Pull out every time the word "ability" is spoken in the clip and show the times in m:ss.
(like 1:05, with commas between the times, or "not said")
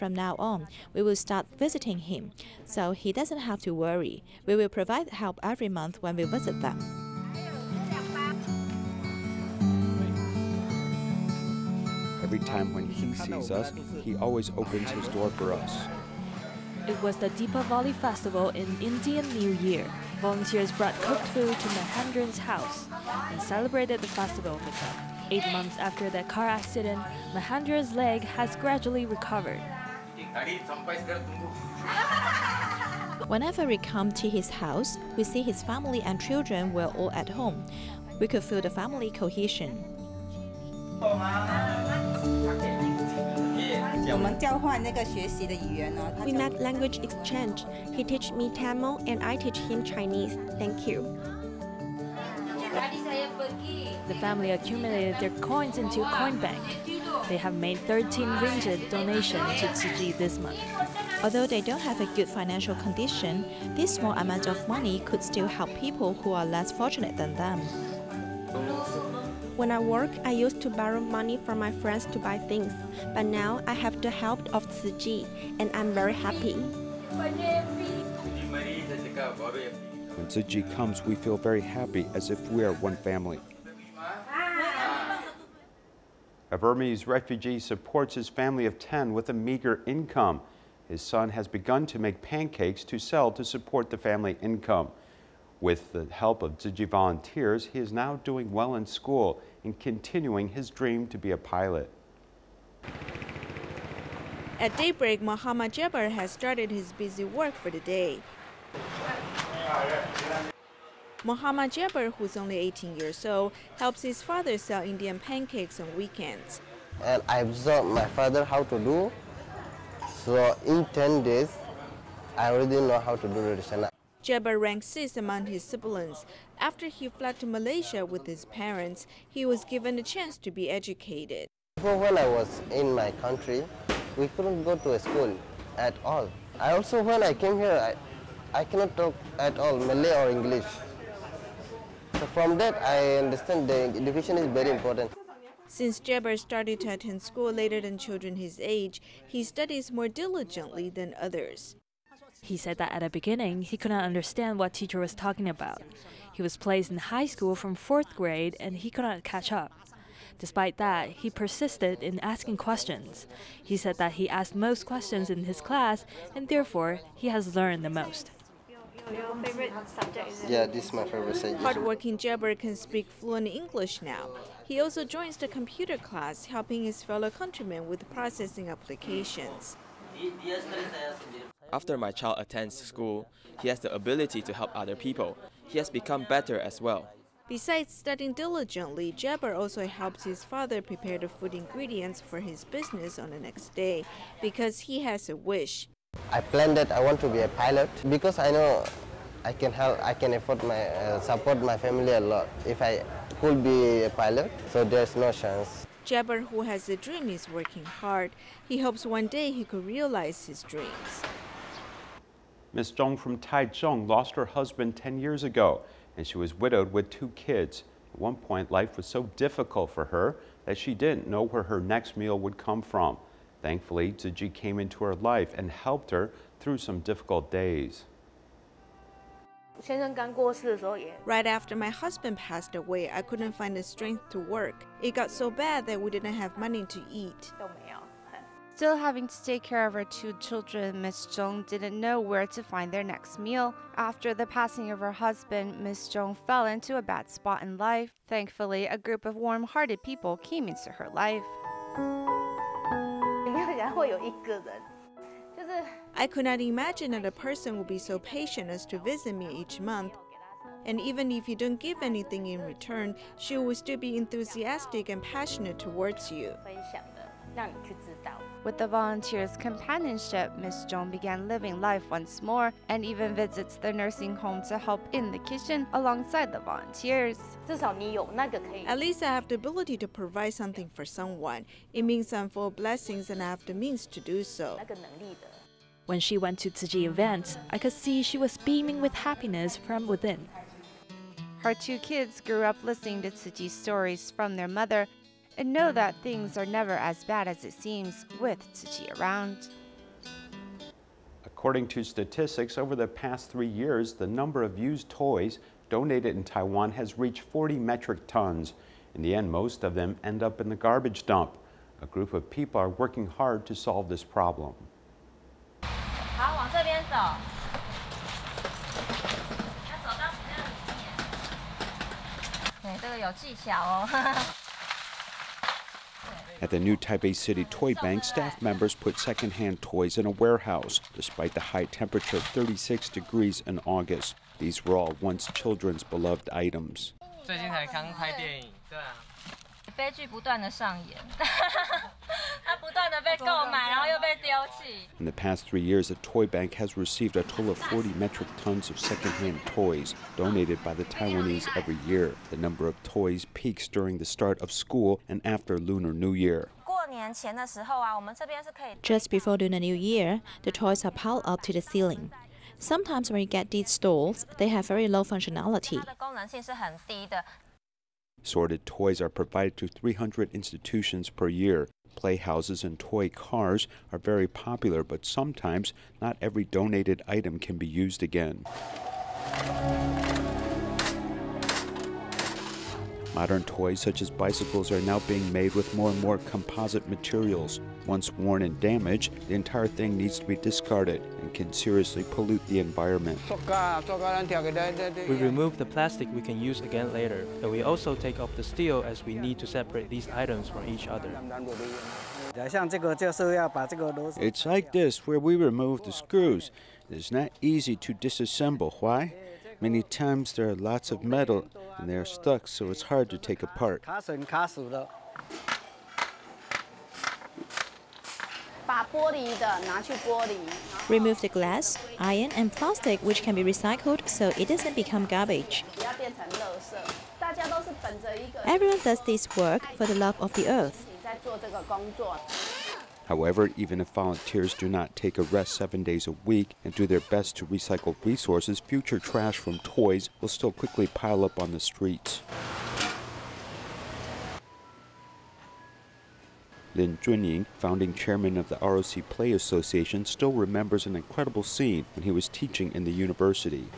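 3:03, 4:39.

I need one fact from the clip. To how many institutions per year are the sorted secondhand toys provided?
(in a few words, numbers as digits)
300.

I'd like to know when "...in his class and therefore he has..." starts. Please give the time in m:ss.
2:45.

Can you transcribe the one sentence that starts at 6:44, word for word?
It's like this where we remove the screws.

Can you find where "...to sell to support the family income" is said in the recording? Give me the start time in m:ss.
1:32.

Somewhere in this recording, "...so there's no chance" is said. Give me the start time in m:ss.
3:24.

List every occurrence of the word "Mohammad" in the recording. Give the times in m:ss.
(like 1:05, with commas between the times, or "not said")
1:45, 1:51.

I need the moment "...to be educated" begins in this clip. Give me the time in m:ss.
2:10.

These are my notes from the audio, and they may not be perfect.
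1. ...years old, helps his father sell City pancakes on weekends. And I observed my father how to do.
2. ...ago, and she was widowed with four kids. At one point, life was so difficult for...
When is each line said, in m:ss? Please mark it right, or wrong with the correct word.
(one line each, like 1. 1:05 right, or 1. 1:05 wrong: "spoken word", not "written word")
1. 1:52 wrong: "Indian", not "City"
2. 3:35 wrong: "two", not "four".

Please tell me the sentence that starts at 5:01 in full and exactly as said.
According to statistics, over the past three years, the number of used toys donated in Taiwan has reached 40 metric tons.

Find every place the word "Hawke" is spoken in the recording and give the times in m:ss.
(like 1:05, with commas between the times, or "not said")
not said.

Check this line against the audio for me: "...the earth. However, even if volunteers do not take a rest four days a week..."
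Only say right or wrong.
wrong.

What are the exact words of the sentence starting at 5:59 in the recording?
Just before Lunar New Year, the toys are piled up to the ceiling.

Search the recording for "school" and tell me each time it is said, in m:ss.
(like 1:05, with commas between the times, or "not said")
1:38, 2:14, 2:27, 2:37, 3:02, 5:54.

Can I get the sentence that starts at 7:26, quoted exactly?
Lin Junying, founding chairman of the ROC Play Association, still remembers an incredible scene when he was teaching in the university.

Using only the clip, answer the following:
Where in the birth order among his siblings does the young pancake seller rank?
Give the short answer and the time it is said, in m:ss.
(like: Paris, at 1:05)
Sixth, at 2:04.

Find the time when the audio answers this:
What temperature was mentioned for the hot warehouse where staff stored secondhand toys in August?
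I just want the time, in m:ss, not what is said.
5:32.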